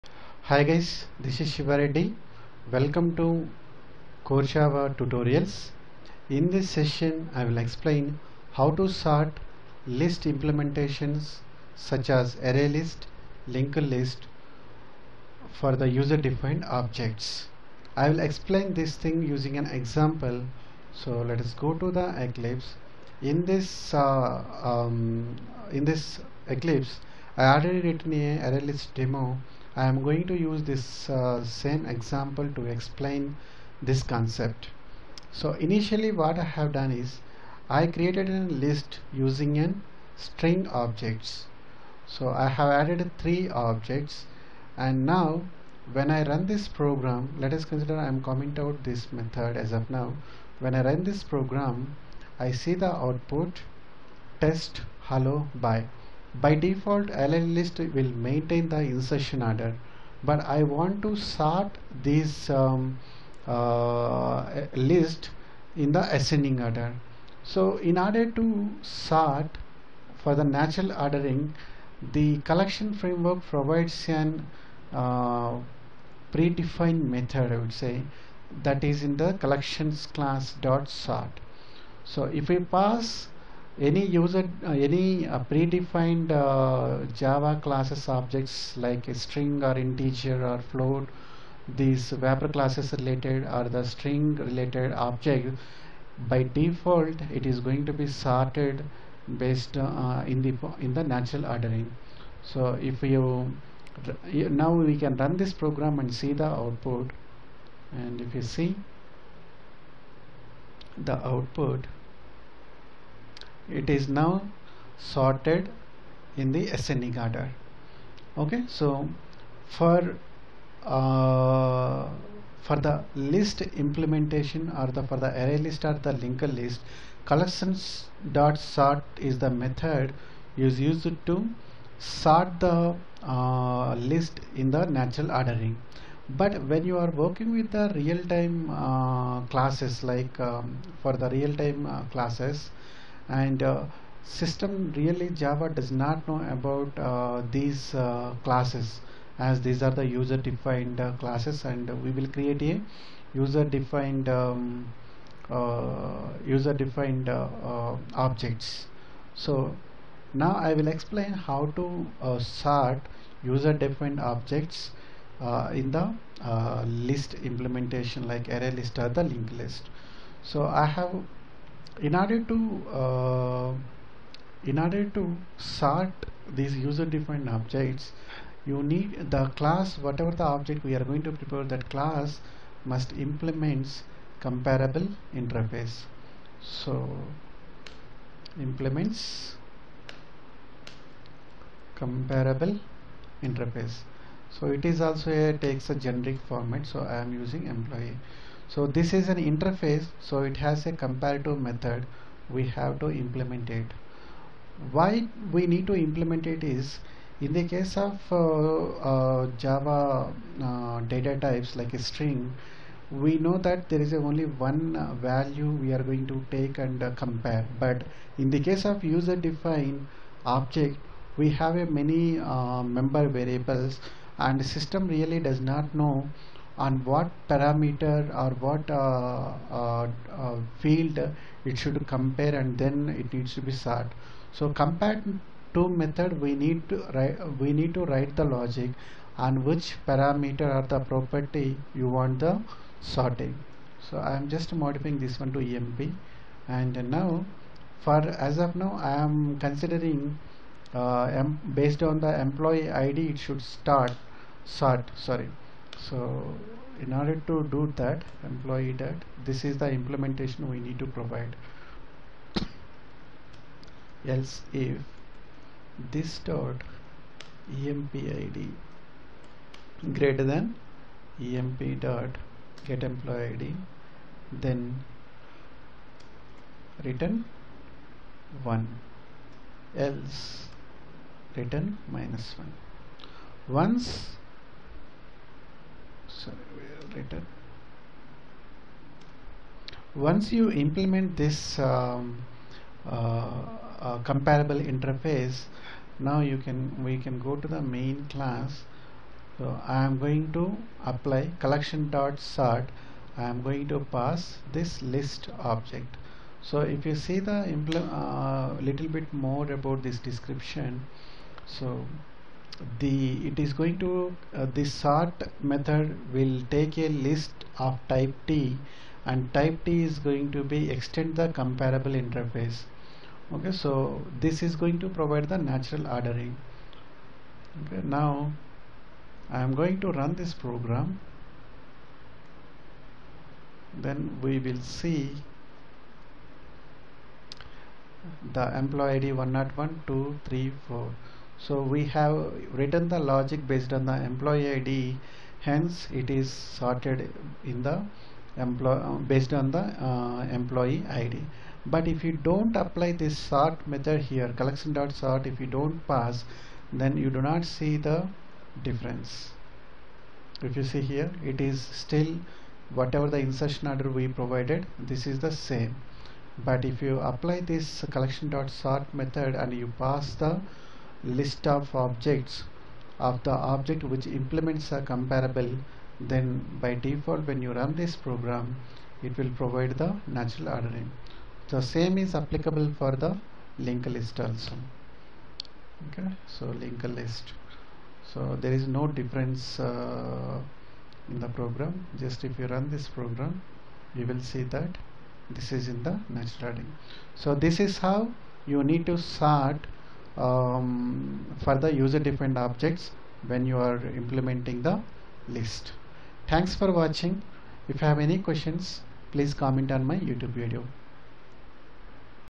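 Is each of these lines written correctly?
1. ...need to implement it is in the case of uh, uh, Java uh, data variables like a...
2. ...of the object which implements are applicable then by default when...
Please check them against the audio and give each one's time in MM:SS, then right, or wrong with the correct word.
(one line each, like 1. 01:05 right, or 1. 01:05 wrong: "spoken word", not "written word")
1. 03:25 wrong: "types", not "variables"
2. 06:13 wrong: "comparable", not "applicable".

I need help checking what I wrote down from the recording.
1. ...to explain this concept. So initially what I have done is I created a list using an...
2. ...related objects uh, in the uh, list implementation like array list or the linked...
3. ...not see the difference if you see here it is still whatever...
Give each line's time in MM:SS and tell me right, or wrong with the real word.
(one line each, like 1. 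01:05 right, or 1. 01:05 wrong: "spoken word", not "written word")
1. 00:32 right
2. 02:43 wrong: "defined", not "related"
3. 05:57 right.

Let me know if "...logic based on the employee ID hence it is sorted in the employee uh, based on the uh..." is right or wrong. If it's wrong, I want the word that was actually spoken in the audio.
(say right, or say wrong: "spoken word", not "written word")
right.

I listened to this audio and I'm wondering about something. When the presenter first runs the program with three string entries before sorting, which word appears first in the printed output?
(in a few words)
test.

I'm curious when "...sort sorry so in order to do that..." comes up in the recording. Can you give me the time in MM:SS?
04:14.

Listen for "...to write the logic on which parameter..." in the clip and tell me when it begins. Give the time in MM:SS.
03:57.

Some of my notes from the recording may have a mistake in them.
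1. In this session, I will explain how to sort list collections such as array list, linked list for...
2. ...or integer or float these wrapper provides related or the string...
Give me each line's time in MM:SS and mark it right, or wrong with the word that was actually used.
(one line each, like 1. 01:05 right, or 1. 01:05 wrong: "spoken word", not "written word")
1. 00:06 wrong: "implementations", not "collections"
2. 01:29 wrong: "classes", not "provides".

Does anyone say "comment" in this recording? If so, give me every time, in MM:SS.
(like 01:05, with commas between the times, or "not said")
00:48, 06:49.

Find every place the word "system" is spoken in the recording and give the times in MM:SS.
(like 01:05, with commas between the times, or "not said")
02:24, 03:44.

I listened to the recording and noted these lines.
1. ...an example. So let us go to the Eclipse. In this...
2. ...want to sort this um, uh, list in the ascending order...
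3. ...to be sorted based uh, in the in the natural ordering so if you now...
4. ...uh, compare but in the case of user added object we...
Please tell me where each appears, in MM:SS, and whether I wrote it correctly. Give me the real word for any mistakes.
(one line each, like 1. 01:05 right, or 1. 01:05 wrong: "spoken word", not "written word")
1. 00:19 right
2. 01:00 right
3. 01:37 right
4. 03:37 wrong: "defined", not "added".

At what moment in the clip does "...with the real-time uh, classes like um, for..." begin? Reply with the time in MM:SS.
02:17.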